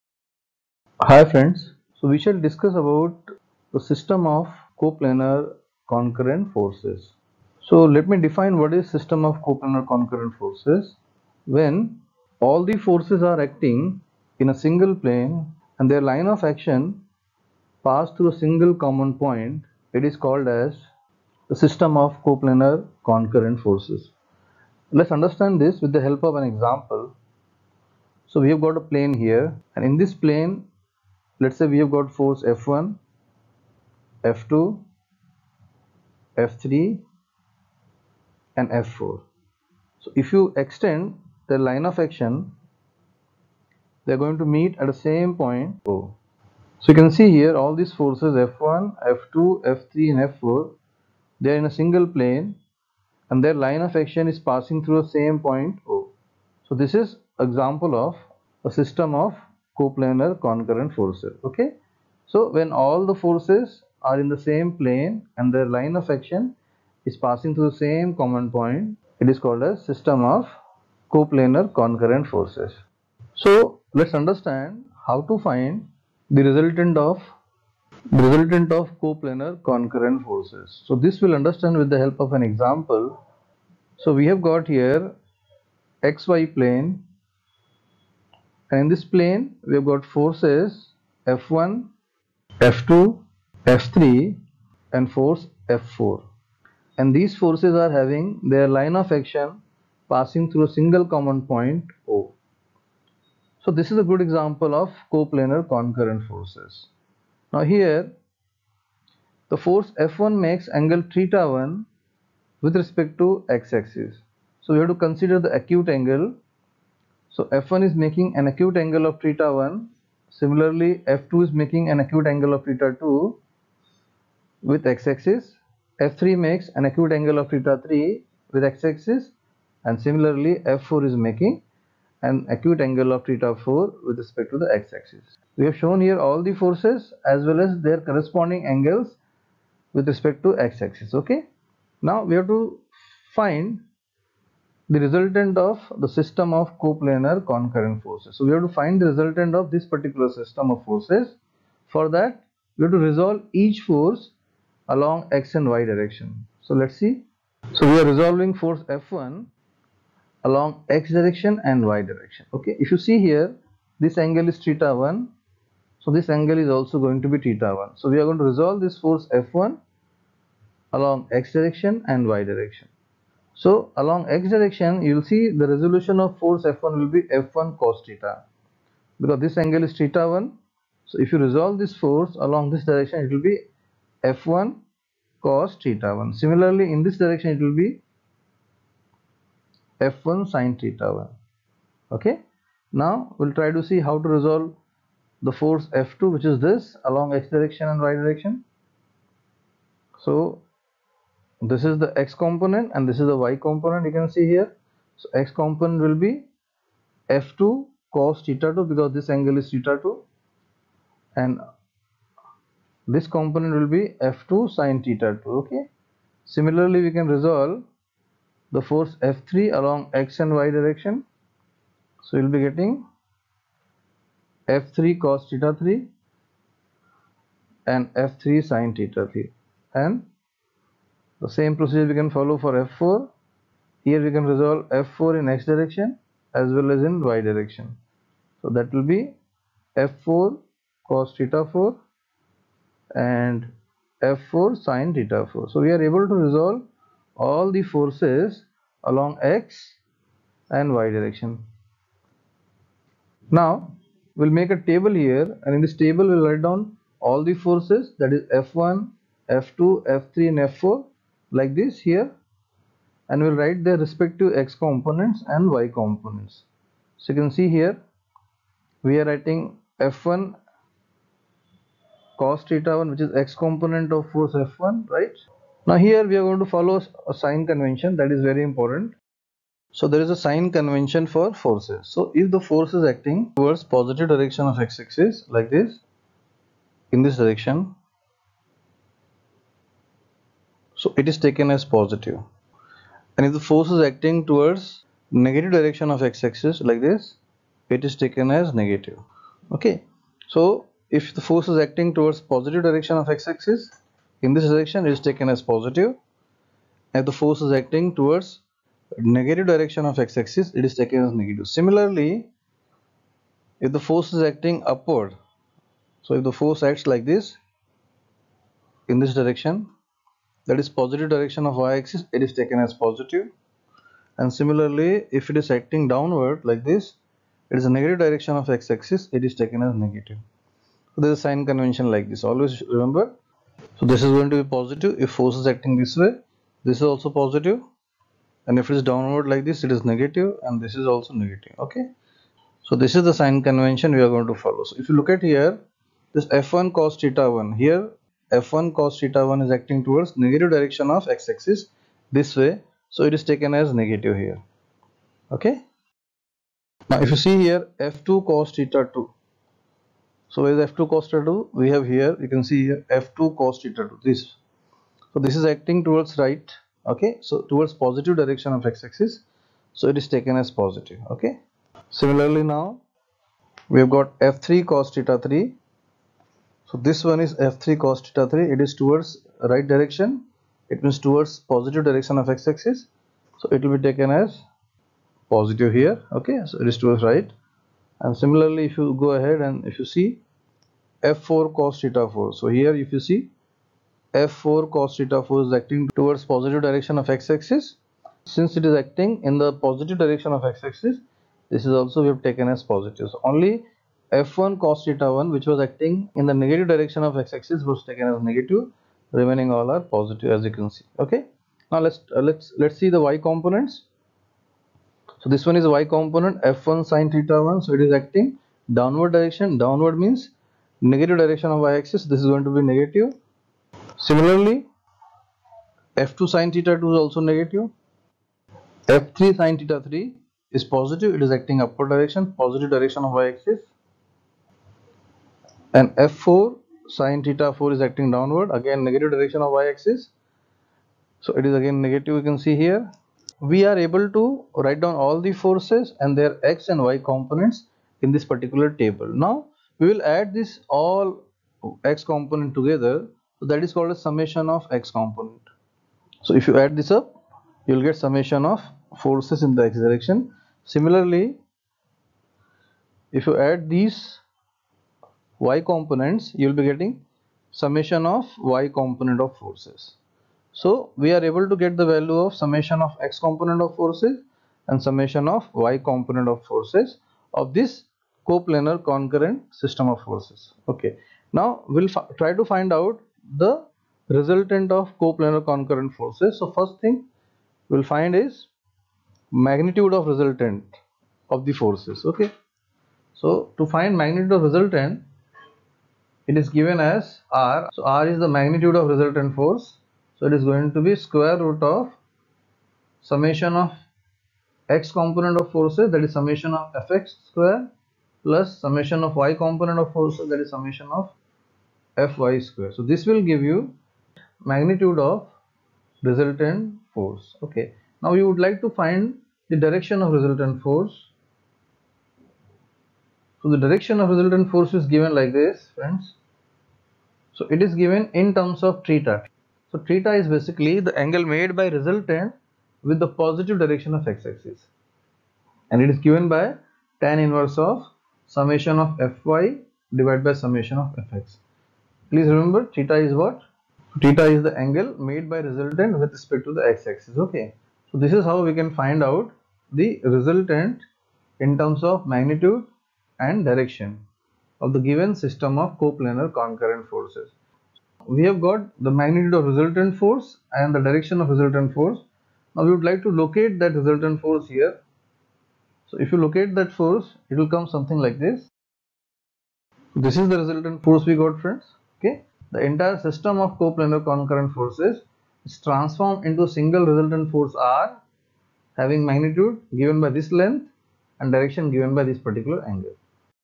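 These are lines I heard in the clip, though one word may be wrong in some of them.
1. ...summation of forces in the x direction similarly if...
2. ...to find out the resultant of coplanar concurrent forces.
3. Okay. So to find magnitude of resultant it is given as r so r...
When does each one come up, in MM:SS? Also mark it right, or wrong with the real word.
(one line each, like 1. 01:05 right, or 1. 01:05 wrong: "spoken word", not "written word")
1. 07:38 right
2. 08:02 right
3. 08:12 right.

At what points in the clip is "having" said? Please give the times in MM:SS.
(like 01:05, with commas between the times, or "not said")
01:37, 09:38.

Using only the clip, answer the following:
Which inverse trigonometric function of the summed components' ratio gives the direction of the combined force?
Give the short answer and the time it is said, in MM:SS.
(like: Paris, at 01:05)
tan inverse, at 08:57.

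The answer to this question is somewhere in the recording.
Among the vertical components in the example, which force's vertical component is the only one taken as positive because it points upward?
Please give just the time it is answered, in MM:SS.
07:09.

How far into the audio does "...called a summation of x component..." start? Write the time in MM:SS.
07:33.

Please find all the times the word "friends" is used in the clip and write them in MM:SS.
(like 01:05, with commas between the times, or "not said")
00:01, 08:45, 09:31.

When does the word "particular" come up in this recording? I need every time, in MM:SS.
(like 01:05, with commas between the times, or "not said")
02:29, 07:28, 09:42.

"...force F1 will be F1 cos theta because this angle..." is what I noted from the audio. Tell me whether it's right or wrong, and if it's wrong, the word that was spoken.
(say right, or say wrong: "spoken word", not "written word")
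right.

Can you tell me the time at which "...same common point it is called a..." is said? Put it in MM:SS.
01:07.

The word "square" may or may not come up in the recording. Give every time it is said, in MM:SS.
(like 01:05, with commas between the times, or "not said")
08:21, 08:27, 08:32.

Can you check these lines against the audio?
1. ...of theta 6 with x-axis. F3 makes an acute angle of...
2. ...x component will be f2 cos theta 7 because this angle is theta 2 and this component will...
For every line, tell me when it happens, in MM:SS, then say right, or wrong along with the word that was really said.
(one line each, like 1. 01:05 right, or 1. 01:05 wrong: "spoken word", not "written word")
1. 02:02 wrong: "2", not "6"
2. 03:25 wrong: "2", not "7".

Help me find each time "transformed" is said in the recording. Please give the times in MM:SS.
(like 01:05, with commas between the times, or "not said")
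09:35.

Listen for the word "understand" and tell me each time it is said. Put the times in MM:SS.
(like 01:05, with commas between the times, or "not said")
00:25, 01:14, 01:21.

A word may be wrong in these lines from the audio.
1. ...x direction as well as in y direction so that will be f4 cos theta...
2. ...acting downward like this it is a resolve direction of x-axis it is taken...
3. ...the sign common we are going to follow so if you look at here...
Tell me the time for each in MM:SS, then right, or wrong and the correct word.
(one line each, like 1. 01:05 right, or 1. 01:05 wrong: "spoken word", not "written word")
1. 03:55 right
2. 05:25 wrong: "negative", not "resolve"
3. 05:43 wrong: "convention", not "common".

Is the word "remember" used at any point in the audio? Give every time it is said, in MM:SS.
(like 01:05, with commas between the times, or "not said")
05:32, 09:02.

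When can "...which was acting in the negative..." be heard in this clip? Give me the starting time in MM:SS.
06:45.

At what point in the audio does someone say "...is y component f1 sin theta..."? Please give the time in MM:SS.
06:55.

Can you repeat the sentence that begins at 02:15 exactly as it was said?
We have shown here all the forces as well as their corresponding angles with respect to x-axis.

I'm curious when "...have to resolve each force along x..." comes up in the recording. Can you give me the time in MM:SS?
02:32.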